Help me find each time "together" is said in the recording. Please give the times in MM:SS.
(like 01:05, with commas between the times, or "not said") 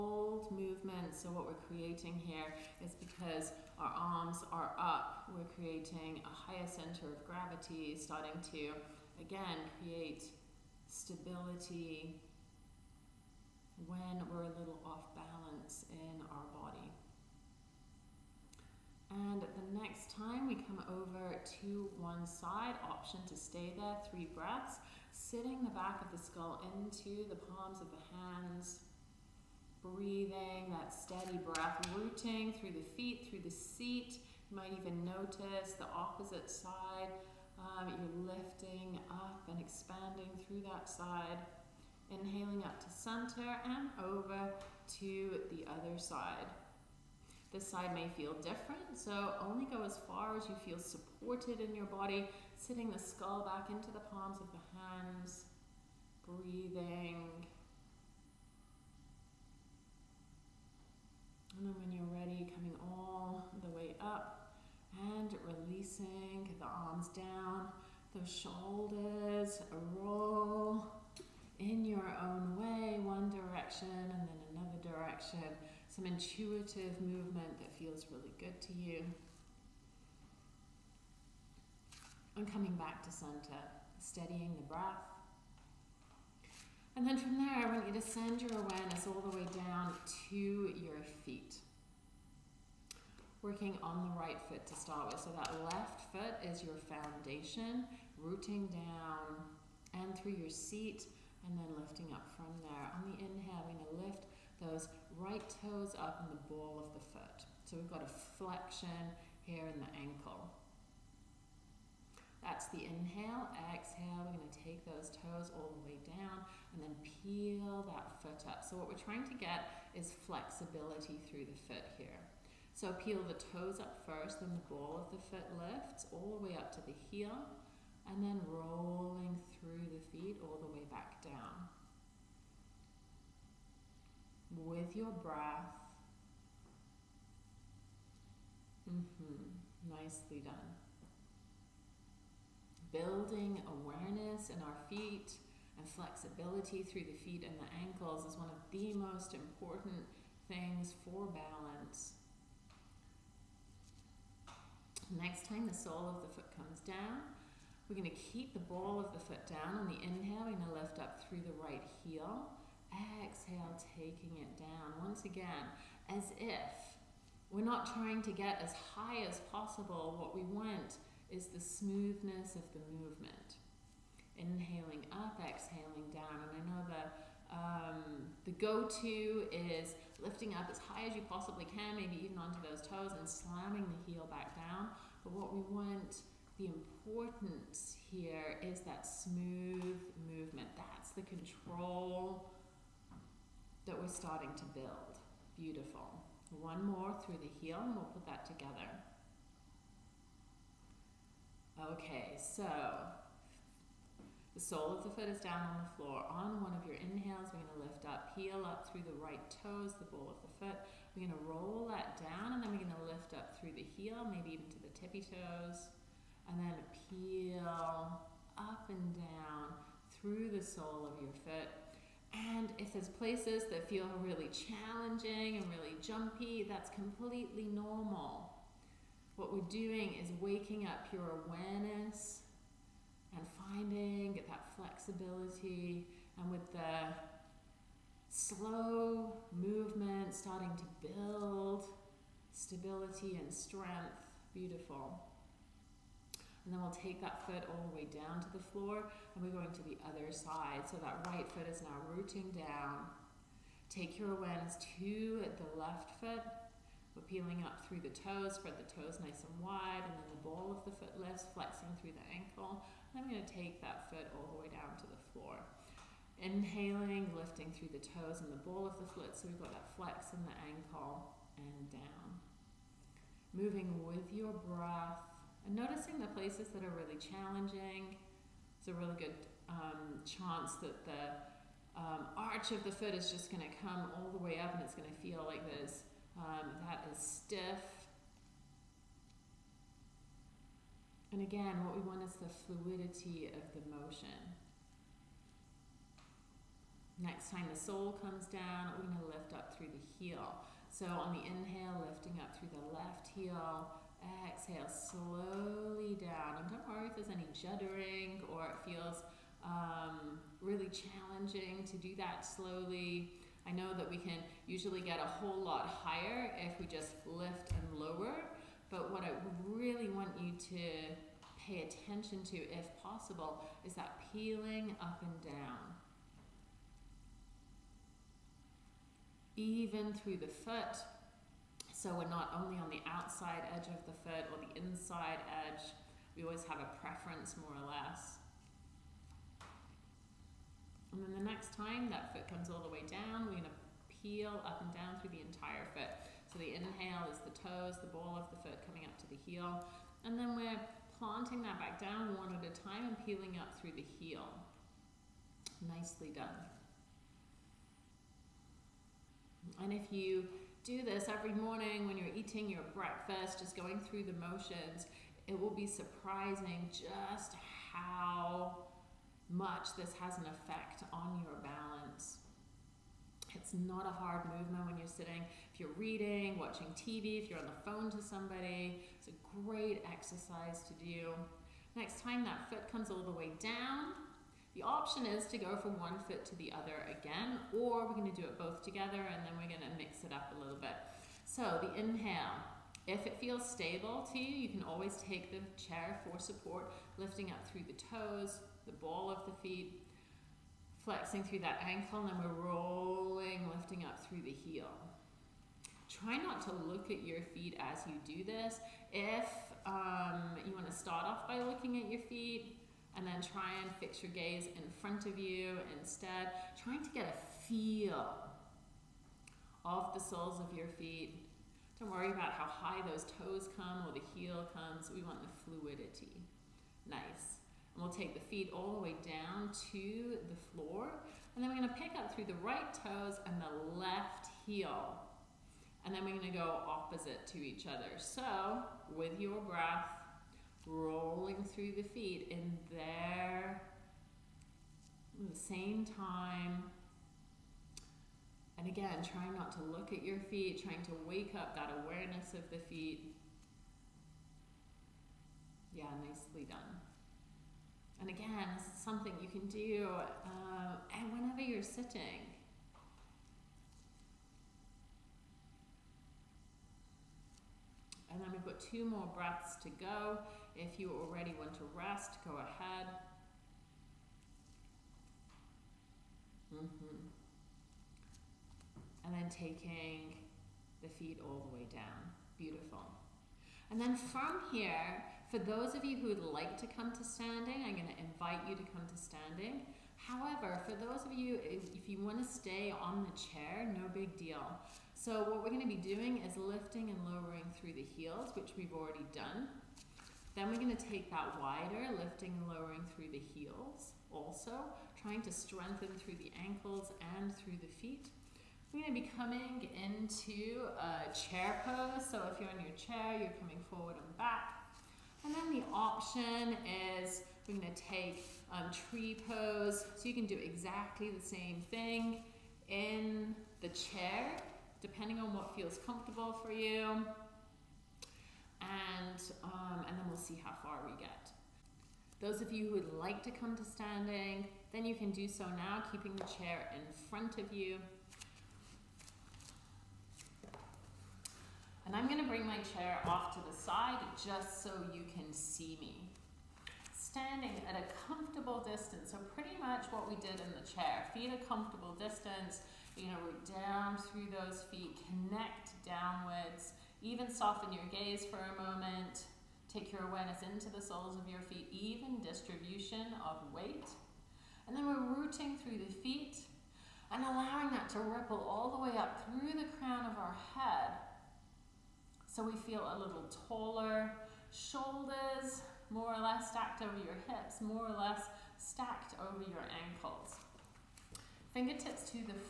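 03:18, 06:28.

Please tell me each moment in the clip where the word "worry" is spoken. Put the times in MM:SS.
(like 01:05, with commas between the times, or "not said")
05:06, 07:02.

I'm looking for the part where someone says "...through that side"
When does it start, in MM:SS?
00:40.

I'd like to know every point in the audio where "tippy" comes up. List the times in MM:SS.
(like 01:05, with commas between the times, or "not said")
03:34.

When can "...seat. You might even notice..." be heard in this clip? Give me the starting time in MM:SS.
00:33.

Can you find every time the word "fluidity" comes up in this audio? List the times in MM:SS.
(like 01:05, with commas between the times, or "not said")
04:52, 07:05.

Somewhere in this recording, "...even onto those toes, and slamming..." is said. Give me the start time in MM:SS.
03:02.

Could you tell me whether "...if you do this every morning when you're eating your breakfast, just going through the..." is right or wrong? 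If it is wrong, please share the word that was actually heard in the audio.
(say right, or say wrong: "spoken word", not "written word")
right.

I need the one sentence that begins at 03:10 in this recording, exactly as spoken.
That's the control that we're starting to build.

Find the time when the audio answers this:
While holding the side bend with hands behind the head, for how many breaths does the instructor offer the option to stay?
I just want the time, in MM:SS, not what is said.
00:24.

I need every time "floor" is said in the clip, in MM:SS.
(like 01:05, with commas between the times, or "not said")
03:25, 04:08, 04:25, 07:10.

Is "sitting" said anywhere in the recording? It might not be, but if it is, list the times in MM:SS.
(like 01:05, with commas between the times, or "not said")
00:25, 00:52, 06:15, 07:41.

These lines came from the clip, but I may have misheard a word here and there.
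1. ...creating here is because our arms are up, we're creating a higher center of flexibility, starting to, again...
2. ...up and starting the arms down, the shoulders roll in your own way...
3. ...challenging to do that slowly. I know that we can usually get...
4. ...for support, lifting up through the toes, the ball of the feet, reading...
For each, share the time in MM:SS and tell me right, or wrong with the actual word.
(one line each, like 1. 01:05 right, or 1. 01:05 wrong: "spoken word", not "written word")
1. 00:01 wrong: "gravity", not "flexibility"
2. 01:04 wrong: "releasing", not "starting"
3. 05:10 right
4. 06:36 wrong: "flexing", not "reading".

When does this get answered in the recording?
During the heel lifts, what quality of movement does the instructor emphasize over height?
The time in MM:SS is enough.
02:51.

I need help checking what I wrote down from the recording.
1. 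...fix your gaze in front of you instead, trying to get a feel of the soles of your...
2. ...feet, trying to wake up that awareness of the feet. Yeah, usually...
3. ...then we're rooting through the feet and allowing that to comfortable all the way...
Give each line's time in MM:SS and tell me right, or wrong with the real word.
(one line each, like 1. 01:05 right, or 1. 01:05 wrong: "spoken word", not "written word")
1. 06:53 right
2. 07:30 wrong: "nicely", not "usually"
3. 09:24 wrong: "ripple", not "comfortable".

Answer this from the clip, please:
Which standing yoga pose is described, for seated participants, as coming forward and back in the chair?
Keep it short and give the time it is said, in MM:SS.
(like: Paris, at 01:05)
chair pose, at 08:31.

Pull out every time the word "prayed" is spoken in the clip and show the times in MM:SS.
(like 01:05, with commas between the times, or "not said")
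not said.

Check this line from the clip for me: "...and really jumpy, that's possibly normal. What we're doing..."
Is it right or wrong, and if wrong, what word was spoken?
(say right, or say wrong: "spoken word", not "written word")
wrong: "completely", not "possibly".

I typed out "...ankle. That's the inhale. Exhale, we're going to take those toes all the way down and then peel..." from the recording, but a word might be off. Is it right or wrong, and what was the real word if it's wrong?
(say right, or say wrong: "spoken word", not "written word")
right.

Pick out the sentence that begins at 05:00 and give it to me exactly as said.
So on the inhale, lifting up through the left heel.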